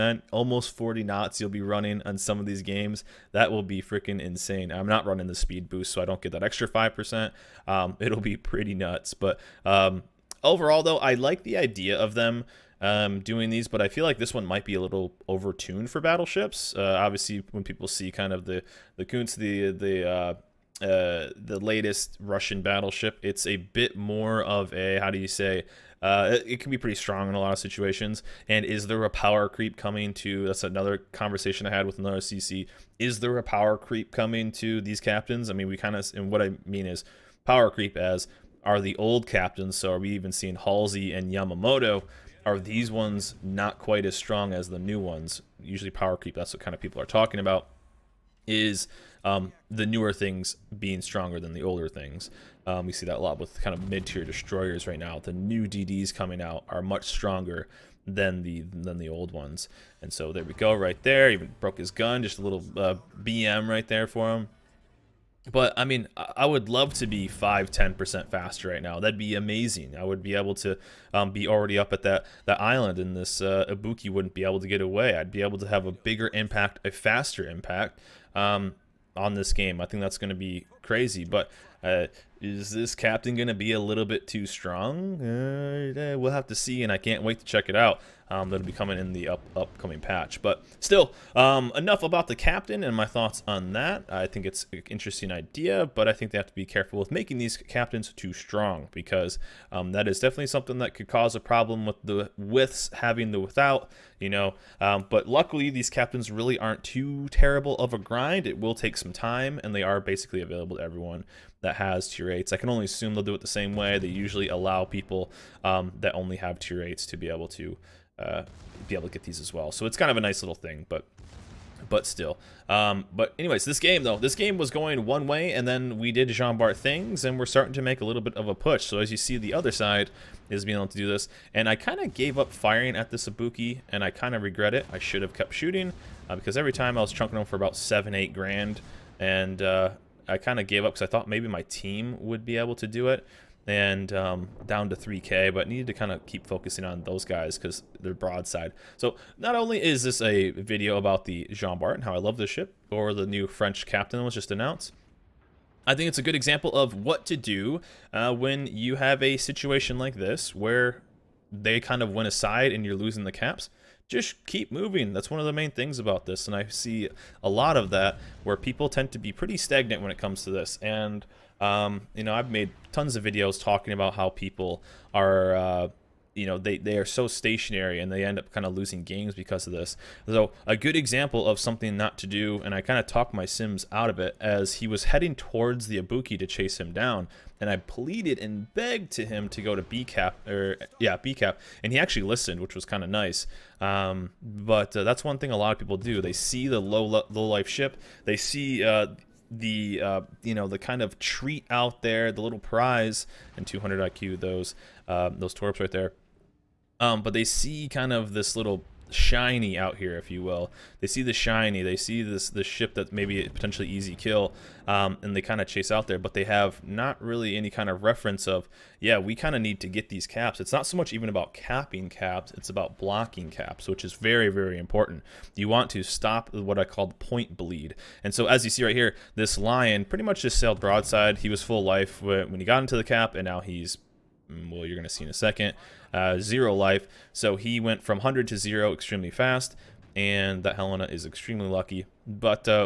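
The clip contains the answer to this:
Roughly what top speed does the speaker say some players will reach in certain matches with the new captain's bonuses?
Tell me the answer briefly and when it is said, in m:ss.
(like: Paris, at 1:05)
almost 40 knots, at 0:00.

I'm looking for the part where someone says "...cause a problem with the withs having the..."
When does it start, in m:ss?
1:41.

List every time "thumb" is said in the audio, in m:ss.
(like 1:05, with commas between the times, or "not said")
not said.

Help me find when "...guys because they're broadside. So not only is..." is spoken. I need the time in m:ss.
2:27.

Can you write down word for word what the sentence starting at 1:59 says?
So it's kind of a nice little thing, but but still.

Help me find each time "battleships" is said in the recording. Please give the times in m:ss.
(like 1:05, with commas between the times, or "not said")
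0:16, 0:22.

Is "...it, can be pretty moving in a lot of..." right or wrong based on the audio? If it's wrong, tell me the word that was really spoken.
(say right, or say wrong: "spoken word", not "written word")
wrong: "strong", not "moving".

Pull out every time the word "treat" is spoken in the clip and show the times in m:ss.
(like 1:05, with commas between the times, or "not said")
3:21.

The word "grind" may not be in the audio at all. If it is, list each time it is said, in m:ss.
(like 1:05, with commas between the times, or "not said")
1:47.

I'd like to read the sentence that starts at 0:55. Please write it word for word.
The new DDs coming out are much stronger than the than the old ones.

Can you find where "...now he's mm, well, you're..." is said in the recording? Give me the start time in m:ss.
3:53.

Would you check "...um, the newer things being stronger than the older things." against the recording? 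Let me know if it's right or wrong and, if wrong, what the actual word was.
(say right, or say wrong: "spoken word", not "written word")
right.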